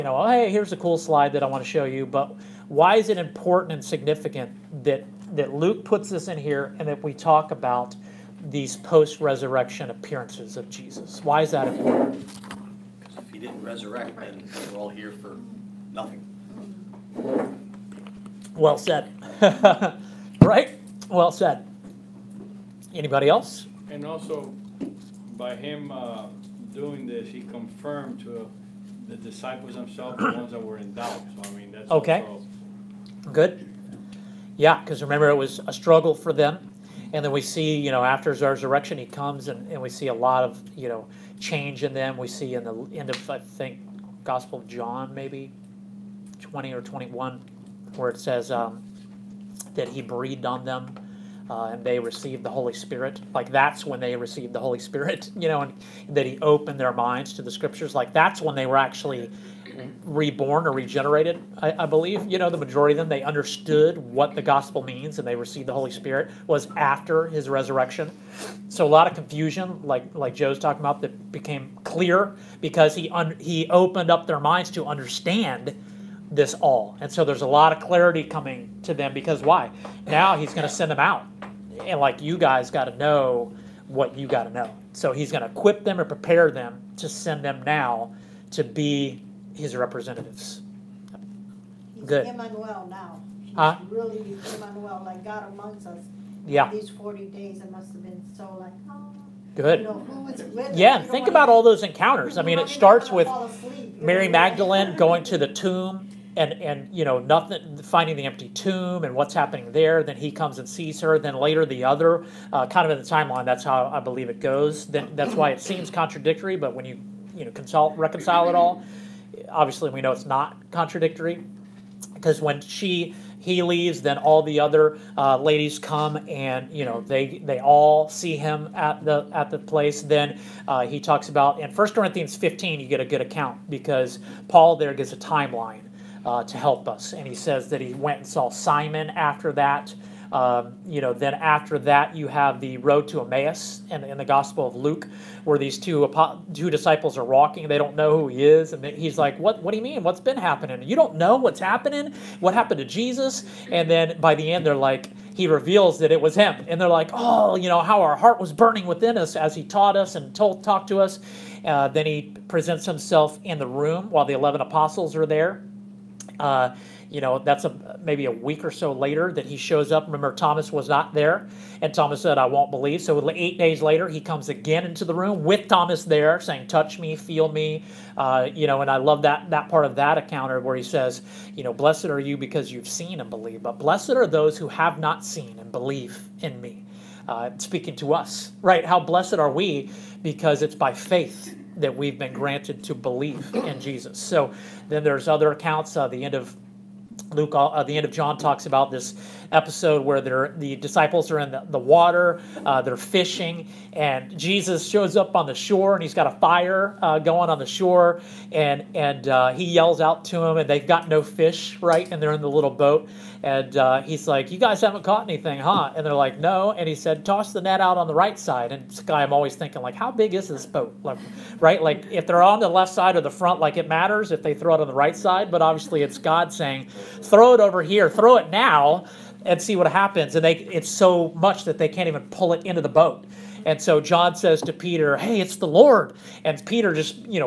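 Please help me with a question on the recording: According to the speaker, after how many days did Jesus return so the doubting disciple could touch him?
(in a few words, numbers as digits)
8.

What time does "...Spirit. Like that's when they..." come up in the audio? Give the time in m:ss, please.
0:52.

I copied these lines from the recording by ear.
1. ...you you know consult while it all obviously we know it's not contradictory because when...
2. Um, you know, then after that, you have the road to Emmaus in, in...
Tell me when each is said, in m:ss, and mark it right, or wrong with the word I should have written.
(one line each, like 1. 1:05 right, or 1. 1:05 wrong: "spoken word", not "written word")
1. 1:56 wrong: "reconcile", not "while"
2. 2:20 right.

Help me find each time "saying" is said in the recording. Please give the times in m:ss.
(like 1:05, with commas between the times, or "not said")
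2:56, 3:46.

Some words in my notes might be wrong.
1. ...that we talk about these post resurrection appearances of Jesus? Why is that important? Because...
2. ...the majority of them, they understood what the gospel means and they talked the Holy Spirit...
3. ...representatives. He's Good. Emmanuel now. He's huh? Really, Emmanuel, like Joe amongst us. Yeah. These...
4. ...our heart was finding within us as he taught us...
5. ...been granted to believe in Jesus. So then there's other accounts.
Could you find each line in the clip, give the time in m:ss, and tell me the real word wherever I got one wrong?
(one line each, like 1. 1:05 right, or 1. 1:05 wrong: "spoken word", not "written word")
1. 0:06 right
2. 1:02 wrong: "received", not "talked"
3. 1:29 wrong: "God", not "Joe"
4. 2:38 wrong: "burning", not "finding"
5. 3:12 right.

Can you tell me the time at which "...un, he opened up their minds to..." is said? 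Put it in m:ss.
1:13.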